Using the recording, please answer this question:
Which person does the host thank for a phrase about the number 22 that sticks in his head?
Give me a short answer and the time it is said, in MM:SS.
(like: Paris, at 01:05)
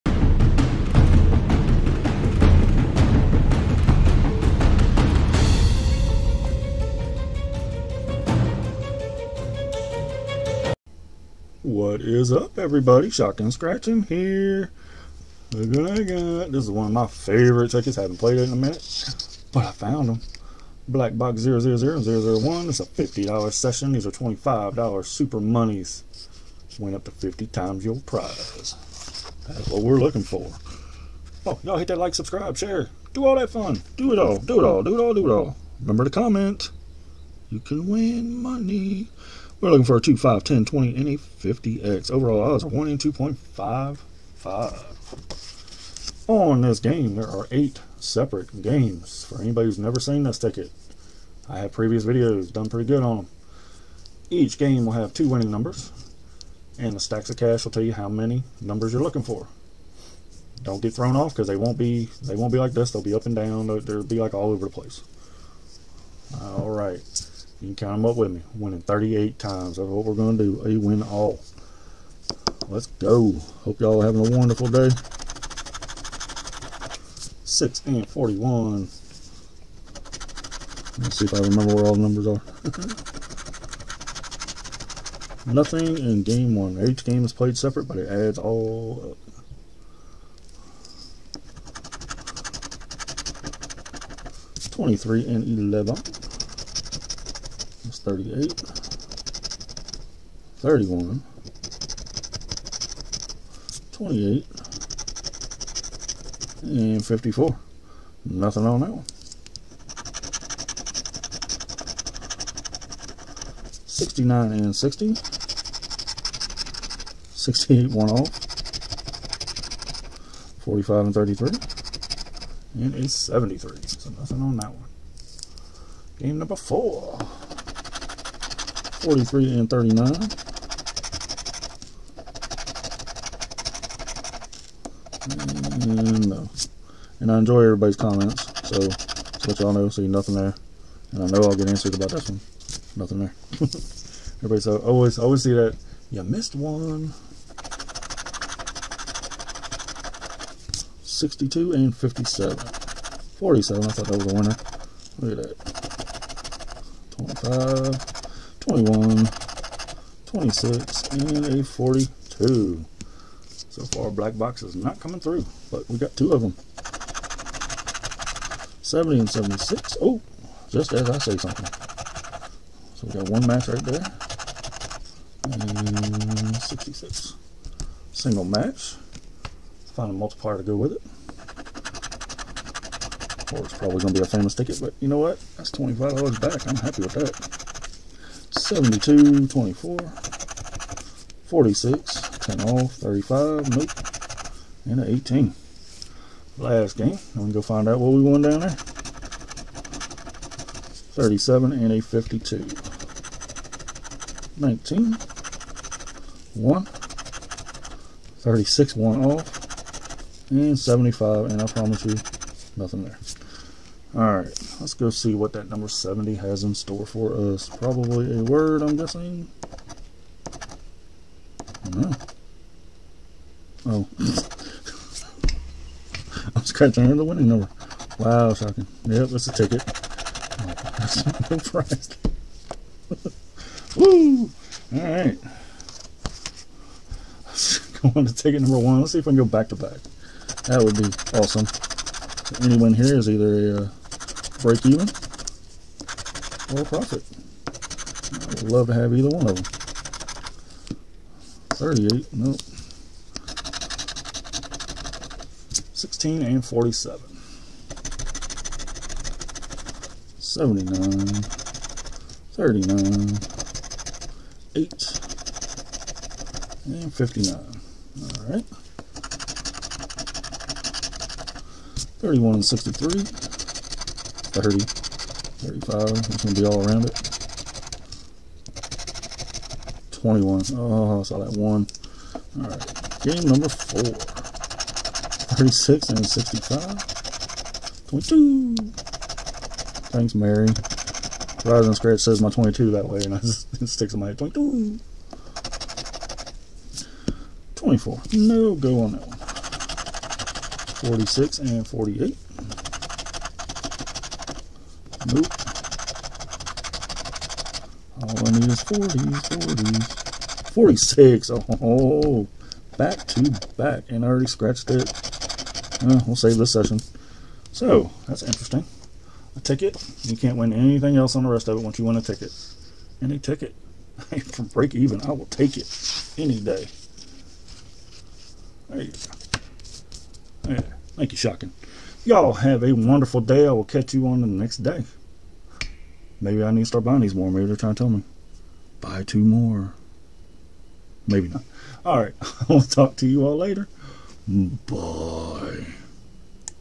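Mary, at 04:50.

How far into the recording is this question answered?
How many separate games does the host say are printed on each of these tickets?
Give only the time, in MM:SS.
00:47.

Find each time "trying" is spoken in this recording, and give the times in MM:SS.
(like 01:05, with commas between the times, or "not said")
05:37.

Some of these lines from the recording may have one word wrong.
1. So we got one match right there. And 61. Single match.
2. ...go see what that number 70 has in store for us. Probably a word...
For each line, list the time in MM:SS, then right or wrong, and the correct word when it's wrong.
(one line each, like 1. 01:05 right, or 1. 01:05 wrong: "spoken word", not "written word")
1. 02:52 wrong: "66", not "61"
2. 03:34 right.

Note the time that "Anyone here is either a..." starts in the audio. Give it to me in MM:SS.
04:02.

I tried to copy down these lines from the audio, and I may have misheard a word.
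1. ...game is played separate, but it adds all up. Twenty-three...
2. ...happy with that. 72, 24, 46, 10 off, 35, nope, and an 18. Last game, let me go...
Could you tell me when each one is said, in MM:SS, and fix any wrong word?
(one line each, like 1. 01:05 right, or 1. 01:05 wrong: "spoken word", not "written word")
1. 01:27 right
2. 03:06 right.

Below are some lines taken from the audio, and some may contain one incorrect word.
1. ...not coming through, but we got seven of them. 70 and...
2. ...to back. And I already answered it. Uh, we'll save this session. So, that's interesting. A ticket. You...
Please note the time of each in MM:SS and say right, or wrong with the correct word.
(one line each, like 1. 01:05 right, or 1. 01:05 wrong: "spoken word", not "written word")
1. 02:44 wrong: "two", not "seven"
2. 05:13 wrong: "scratched", not "answered".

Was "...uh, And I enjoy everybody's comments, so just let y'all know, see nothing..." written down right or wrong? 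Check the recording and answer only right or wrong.
right.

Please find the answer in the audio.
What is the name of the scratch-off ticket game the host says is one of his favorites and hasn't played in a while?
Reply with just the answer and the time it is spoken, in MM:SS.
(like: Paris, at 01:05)
Black Box 001, at 00:20.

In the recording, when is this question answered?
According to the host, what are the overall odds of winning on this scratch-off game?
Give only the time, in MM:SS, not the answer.
00:42.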